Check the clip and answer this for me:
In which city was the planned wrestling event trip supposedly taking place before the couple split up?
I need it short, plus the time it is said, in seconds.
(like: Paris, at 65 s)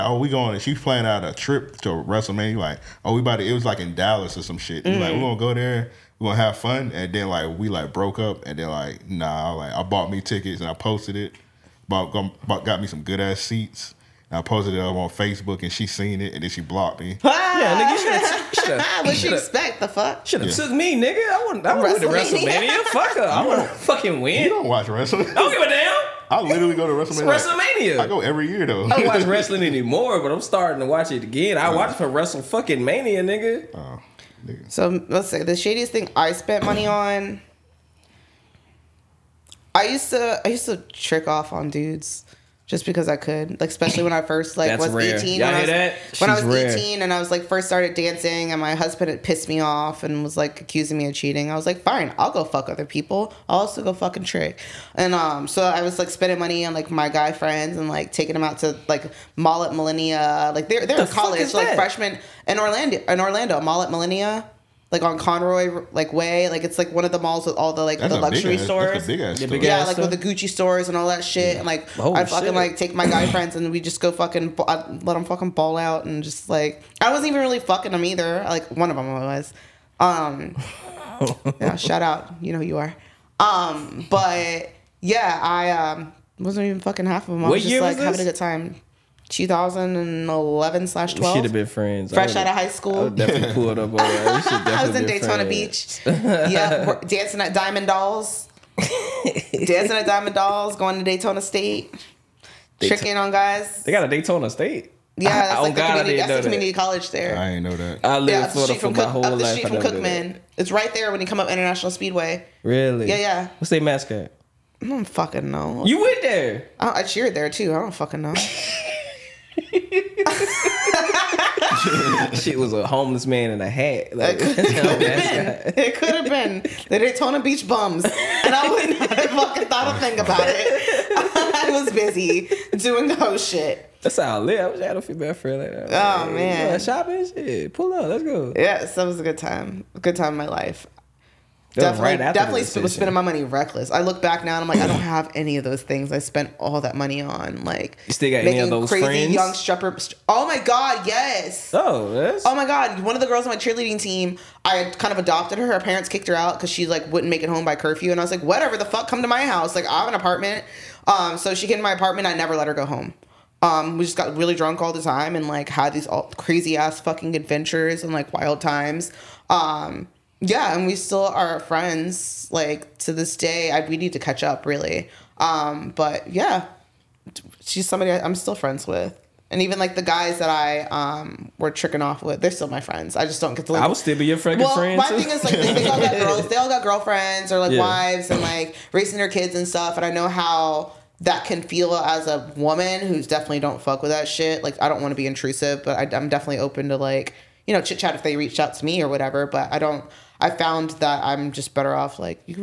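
Dallas, at 3 s.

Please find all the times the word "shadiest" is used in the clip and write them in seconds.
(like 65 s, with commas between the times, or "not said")
35 s.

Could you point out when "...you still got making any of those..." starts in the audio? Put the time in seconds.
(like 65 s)
148 s.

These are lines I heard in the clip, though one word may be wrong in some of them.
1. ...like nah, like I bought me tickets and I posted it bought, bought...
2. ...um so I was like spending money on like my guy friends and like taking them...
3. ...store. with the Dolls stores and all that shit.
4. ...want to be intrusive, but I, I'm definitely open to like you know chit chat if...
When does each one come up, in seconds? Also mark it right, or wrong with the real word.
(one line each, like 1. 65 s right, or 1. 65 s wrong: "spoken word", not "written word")
1. 8 s right
2. 55 s right
3. 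69 s wrong: "Gucci", not "Dolls"
4. 194 s right.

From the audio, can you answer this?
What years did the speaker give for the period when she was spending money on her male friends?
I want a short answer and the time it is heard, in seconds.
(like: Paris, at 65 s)
2011/12, at 89 s.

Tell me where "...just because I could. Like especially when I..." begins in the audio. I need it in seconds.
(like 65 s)
42 s.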